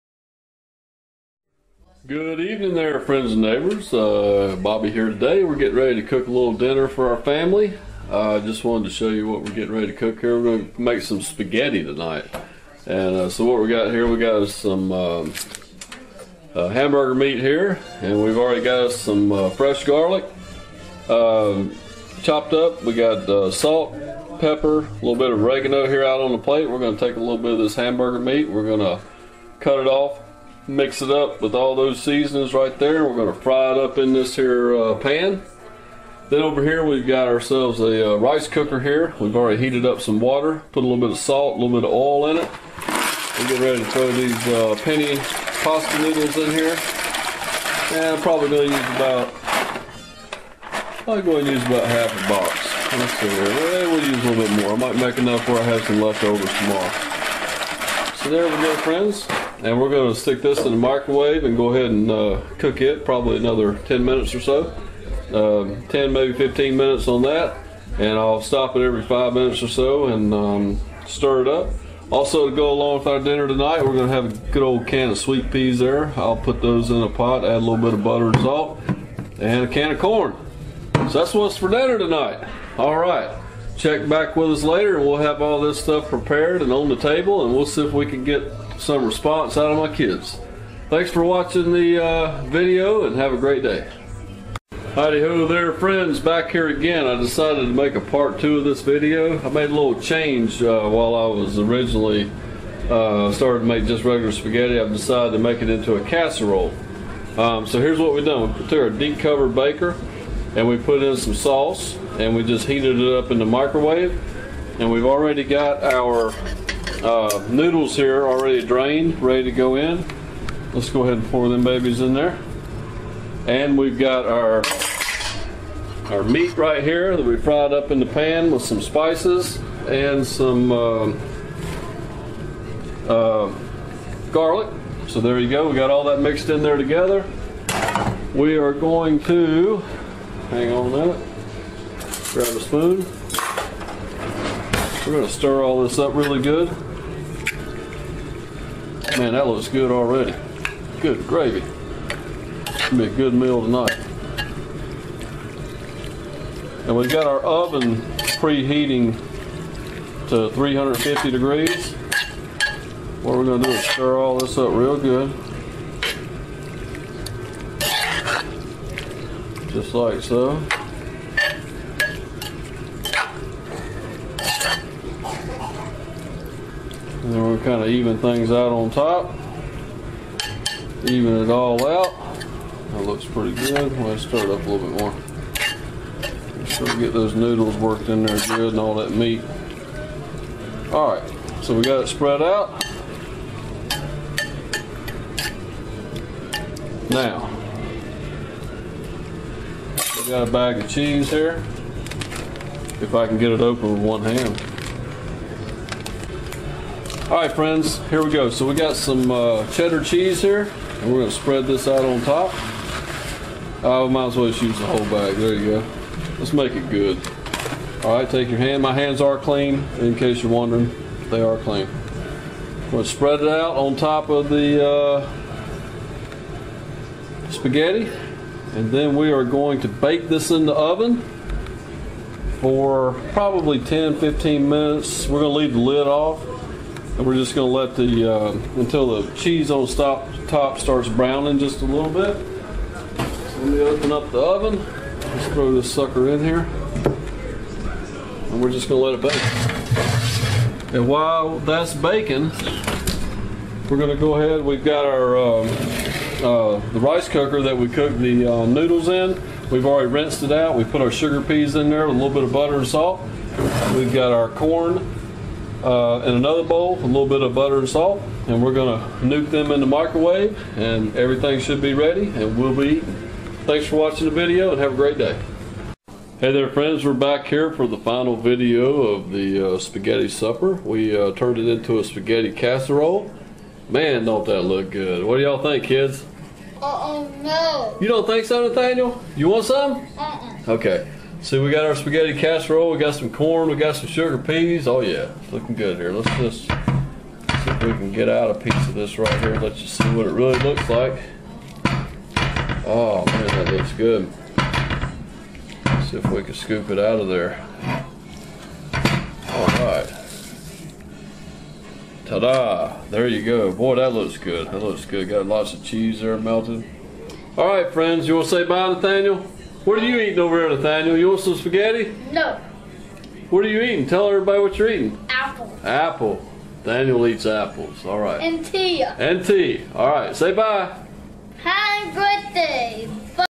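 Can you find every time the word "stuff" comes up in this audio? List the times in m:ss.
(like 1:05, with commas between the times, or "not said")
1:25.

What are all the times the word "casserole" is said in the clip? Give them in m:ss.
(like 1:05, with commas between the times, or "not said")
1:46, 4:42, 4:52.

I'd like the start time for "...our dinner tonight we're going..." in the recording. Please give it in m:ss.
1:13.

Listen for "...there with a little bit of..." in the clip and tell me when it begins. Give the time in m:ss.
4:21.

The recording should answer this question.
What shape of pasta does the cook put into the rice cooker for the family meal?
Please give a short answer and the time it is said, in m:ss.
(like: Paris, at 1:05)
penne, at 0:44.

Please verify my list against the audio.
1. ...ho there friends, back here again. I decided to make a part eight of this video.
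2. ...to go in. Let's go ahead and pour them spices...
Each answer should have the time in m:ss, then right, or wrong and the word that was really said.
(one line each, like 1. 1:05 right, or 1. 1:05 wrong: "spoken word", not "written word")
1. 1:35 wrong: "two", not "eight"
2. 1:59 wrong: "babies", not "spices".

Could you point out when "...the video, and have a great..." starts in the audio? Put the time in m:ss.
4:34.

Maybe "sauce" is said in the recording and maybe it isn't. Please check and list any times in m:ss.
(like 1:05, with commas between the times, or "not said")
1:51.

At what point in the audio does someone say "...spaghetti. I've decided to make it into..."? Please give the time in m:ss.
1:44.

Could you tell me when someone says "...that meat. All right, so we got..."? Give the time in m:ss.
3:08.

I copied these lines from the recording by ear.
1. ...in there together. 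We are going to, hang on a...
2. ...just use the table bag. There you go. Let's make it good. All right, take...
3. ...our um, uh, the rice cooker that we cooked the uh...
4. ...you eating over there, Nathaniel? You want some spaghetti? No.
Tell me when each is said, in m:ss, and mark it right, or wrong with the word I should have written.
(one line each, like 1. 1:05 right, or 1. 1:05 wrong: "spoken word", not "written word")
1. 2:16 right
2. 3:34 wrong: "whole", not "table"
3. 4:15 right
4. 5:20 right.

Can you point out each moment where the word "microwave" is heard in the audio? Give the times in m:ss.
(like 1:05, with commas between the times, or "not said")
1:00, 1:53, 4:29.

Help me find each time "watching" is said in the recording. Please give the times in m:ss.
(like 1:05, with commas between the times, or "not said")
1:31, 4:33.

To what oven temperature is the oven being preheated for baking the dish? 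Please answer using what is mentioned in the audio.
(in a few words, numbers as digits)
350 degrees.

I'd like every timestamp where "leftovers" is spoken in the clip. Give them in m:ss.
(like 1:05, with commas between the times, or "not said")
0:55.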